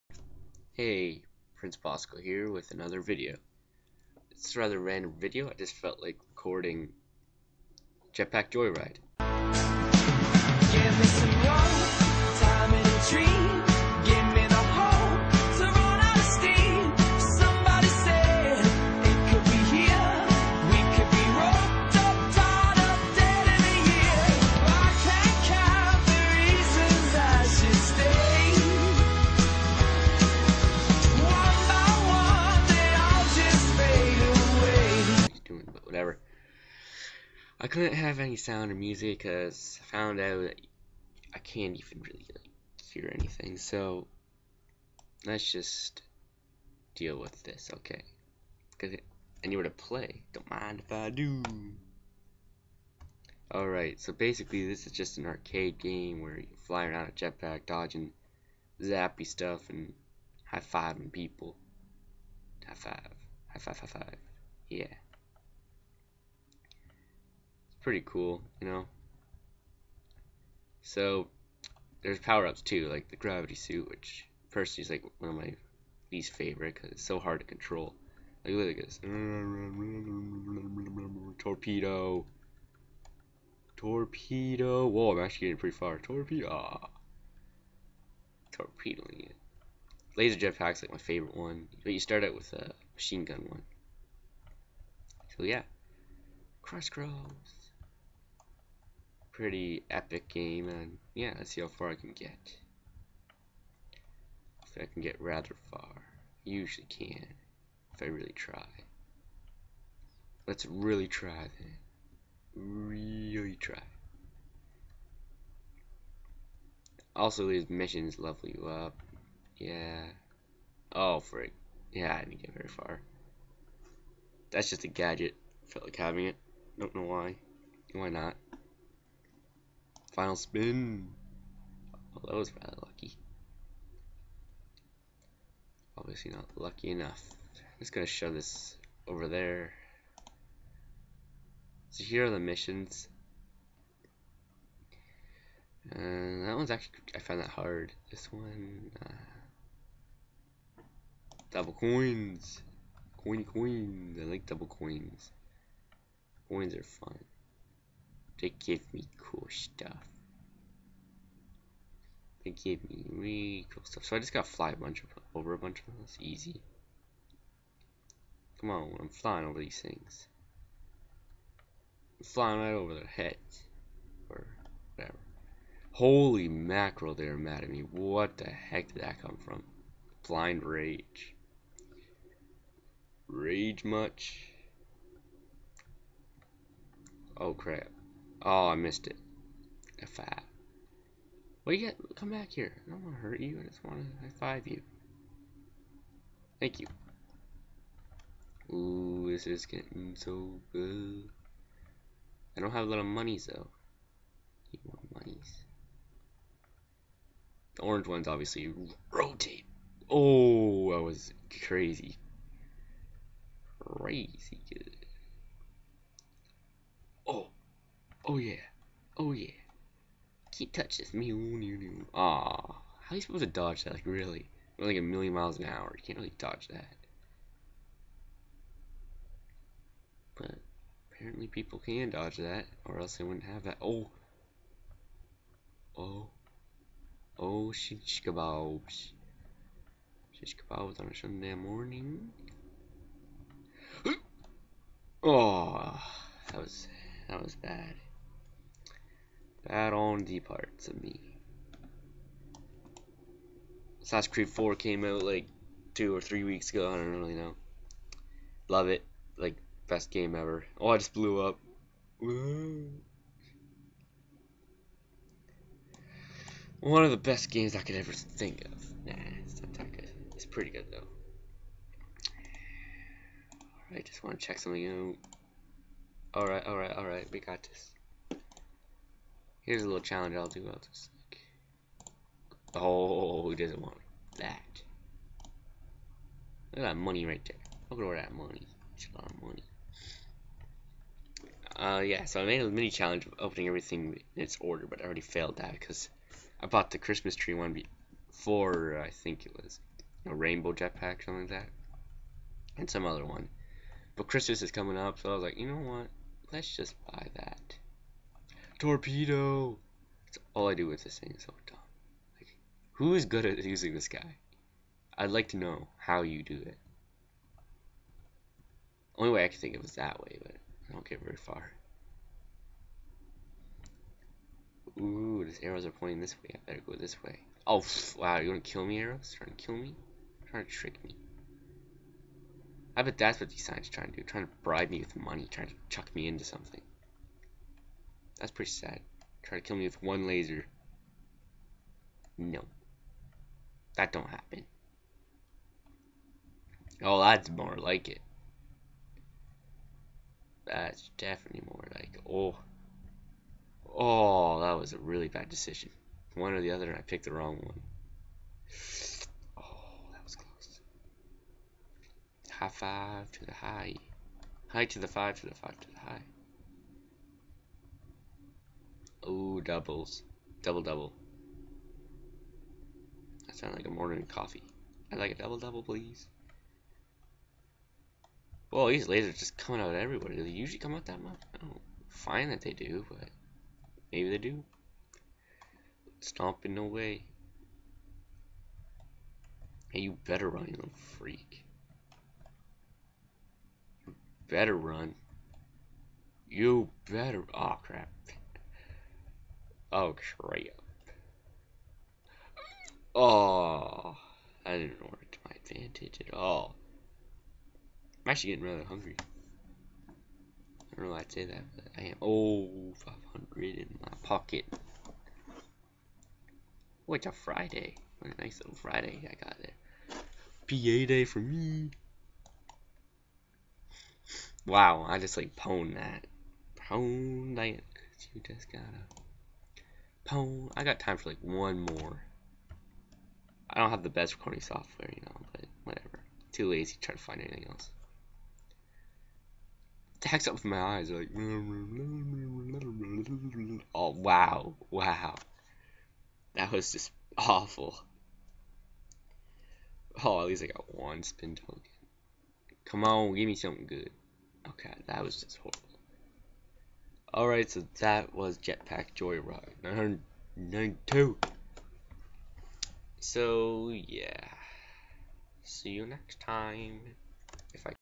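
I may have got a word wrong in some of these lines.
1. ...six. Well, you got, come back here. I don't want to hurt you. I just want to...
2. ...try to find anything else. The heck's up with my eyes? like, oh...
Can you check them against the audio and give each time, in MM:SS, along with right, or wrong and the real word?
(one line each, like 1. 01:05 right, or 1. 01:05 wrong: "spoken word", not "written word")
1. 03:10 wrong: "five", not "six"
2. 07:17 right.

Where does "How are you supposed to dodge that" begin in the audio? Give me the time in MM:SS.
03:43.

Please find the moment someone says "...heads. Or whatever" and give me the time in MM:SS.
02:53.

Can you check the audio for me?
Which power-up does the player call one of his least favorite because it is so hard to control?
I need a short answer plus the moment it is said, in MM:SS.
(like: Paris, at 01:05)
Gravity suit, at 01:13.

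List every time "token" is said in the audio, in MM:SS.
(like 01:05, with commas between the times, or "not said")
07:31.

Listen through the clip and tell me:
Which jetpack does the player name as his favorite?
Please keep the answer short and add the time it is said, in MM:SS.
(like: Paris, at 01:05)
Laser jetpack, at 01:30.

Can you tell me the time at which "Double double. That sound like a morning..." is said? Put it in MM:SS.
06:10.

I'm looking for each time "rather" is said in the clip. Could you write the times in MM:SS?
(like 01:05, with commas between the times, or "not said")
00:04, 01:45, 02:12, 06:48.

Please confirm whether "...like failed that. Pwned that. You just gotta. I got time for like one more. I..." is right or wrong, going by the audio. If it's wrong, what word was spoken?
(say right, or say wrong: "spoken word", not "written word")
wrong: "pwned", not "failed".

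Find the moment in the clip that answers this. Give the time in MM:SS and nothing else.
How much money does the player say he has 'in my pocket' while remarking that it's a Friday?
06:52.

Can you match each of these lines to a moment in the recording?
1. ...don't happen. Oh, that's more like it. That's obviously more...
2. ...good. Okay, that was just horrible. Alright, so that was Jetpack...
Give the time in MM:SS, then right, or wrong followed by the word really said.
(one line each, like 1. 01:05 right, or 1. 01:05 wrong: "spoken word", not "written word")
1. 05:44 wrong: "definitely", not "obviously"
2. 07:33 right.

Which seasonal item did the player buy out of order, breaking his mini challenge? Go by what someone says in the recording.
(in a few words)
Christmas tree.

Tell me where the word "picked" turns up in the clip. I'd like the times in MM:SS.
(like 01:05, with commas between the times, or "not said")
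05:57.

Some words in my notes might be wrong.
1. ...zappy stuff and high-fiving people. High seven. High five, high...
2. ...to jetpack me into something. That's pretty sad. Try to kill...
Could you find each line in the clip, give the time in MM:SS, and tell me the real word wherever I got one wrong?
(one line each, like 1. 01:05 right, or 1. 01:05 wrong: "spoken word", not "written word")
1. 00:58 wrong: "five", not "seven"
2. 05:35 wrong: "chuck", not "jetpack".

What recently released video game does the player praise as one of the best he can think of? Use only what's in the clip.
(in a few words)
Assassin's Creed 4.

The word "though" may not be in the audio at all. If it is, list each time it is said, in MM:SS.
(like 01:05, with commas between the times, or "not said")
03:23, 04:30.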